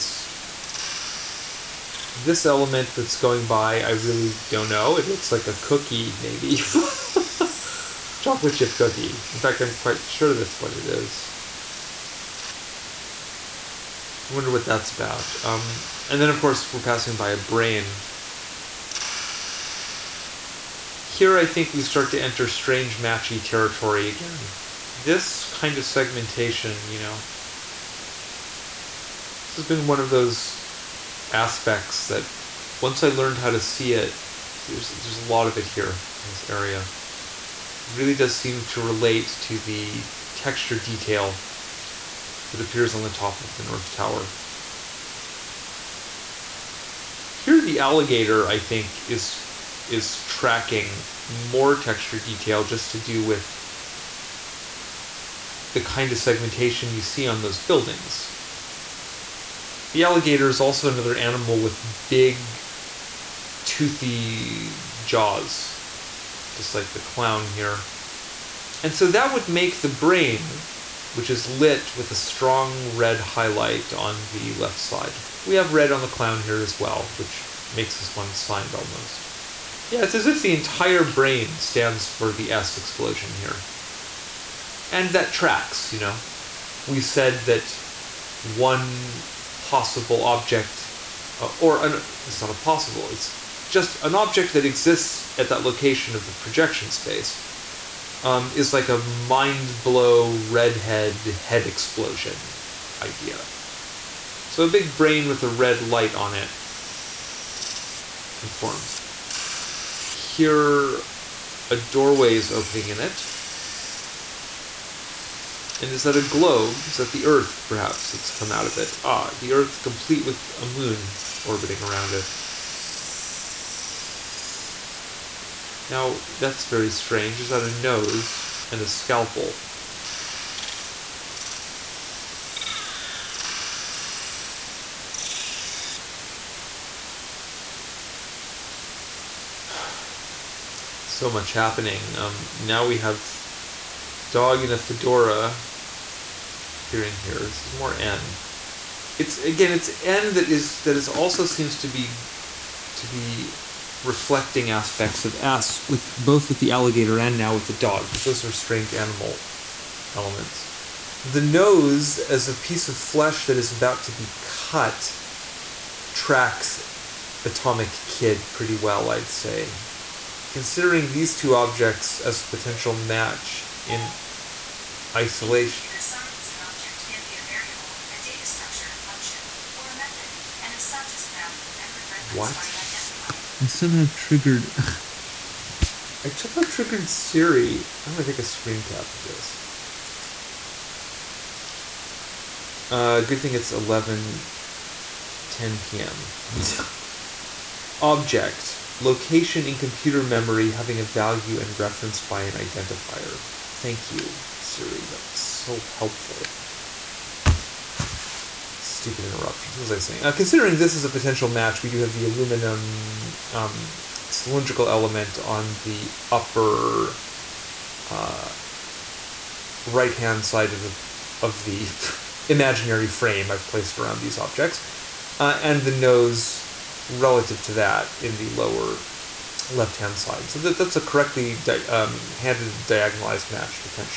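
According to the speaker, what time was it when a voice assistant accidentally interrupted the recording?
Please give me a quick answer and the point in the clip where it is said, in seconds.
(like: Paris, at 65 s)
11:10 p.m., at 193 s.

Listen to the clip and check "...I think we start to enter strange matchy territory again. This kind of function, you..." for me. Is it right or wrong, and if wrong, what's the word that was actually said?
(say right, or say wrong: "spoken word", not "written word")
wrong: "segmentation", not "function".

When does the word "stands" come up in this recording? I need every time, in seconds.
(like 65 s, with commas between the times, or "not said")
81 s.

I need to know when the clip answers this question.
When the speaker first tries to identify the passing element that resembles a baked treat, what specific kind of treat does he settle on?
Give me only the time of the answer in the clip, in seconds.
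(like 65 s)
8 s.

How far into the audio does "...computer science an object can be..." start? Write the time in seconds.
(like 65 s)
175 s.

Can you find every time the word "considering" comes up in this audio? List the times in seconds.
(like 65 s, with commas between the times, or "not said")
170 s, 210 s.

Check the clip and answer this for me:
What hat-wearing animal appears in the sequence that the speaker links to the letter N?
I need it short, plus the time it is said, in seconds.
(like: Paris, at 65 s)
dog in a fedora, at 144 s.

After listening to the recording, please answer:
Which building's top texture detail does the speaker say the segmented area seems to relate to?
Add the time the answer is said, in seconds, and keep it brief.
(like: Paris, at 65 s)
North Tower, at 43 s.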